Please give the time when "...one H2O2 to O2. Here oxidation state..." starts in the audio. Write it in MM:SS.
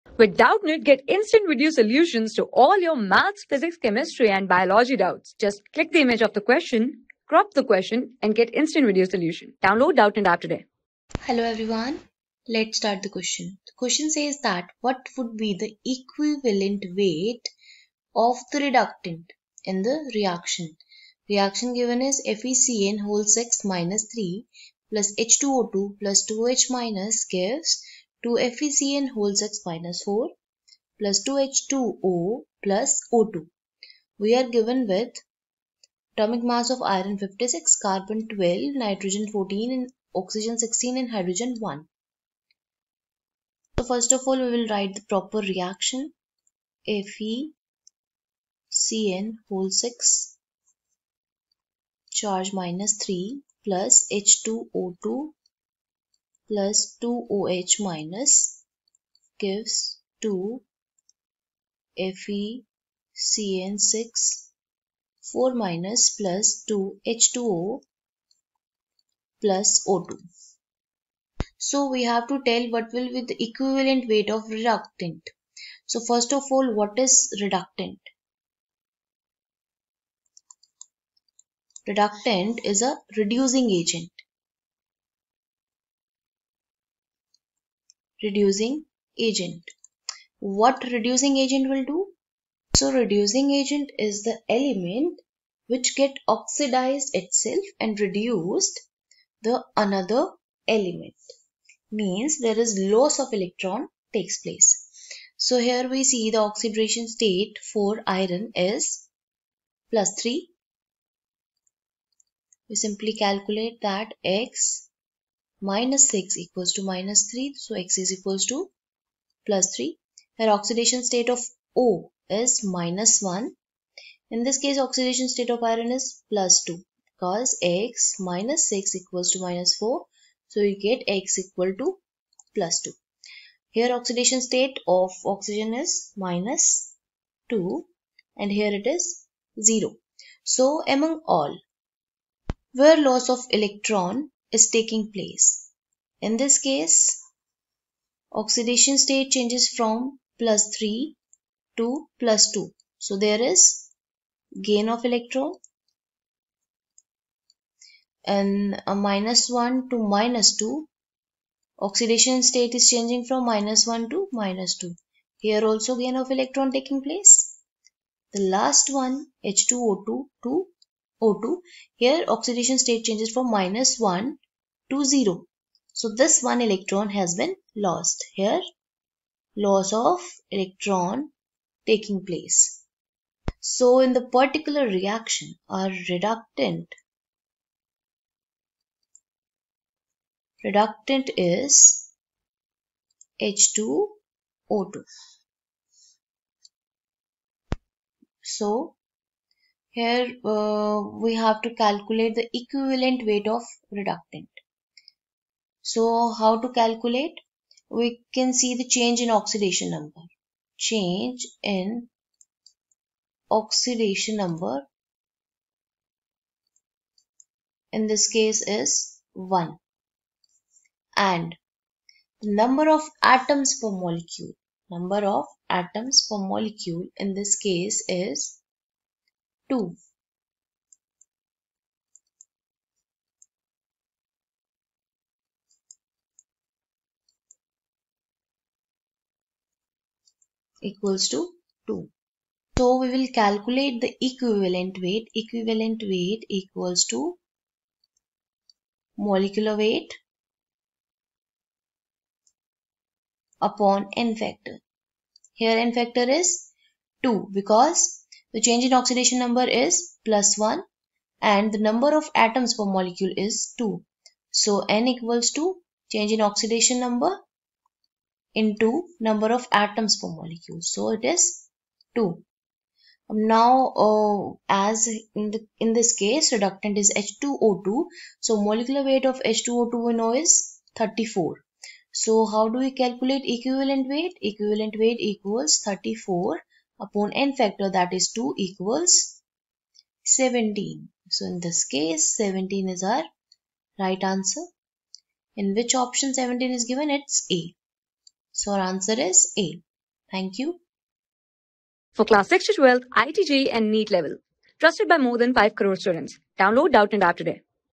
02:48.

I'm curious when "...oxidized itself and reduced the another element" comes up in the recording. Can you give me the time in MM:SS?
01:36.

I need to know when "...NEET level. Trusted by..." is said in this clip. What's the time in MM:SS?
05:03.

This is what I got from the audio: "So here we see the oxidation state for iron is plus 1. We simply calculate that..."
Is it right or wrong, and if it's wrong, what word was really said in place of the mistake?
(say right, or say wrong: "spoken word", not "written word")
wrong: "3", not "1".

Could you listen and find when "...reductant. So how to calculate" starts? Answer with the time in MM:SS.
03:23.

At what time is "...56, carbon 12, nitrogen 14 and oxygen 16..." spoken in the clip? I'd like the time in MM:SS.
00:37.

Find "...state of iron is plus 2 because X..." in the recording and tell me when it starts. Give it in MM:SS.
02:05.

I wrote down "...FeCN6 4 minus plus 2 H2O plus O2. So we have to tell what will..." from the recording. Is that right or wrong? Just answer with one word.
right.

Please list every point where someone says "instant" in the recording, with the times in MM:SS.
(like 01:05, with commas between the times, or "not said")
00:01, 00:08.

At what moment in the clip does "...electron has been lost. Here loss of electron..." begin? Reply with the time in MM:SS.
02:56.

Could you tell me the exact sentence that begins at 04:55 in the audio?
In which option 17 is given?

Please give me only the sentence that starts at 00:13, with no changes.
The question says that what would be the equivalent weight of the reductant in the reaction?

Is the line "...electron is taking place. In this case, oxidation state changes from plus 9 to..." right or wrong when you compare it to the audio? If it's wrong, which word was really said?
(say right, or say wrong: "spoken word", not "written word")
wrong: "3", not "9".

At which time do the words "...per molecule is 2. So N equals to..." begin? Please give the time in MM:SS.
04:22.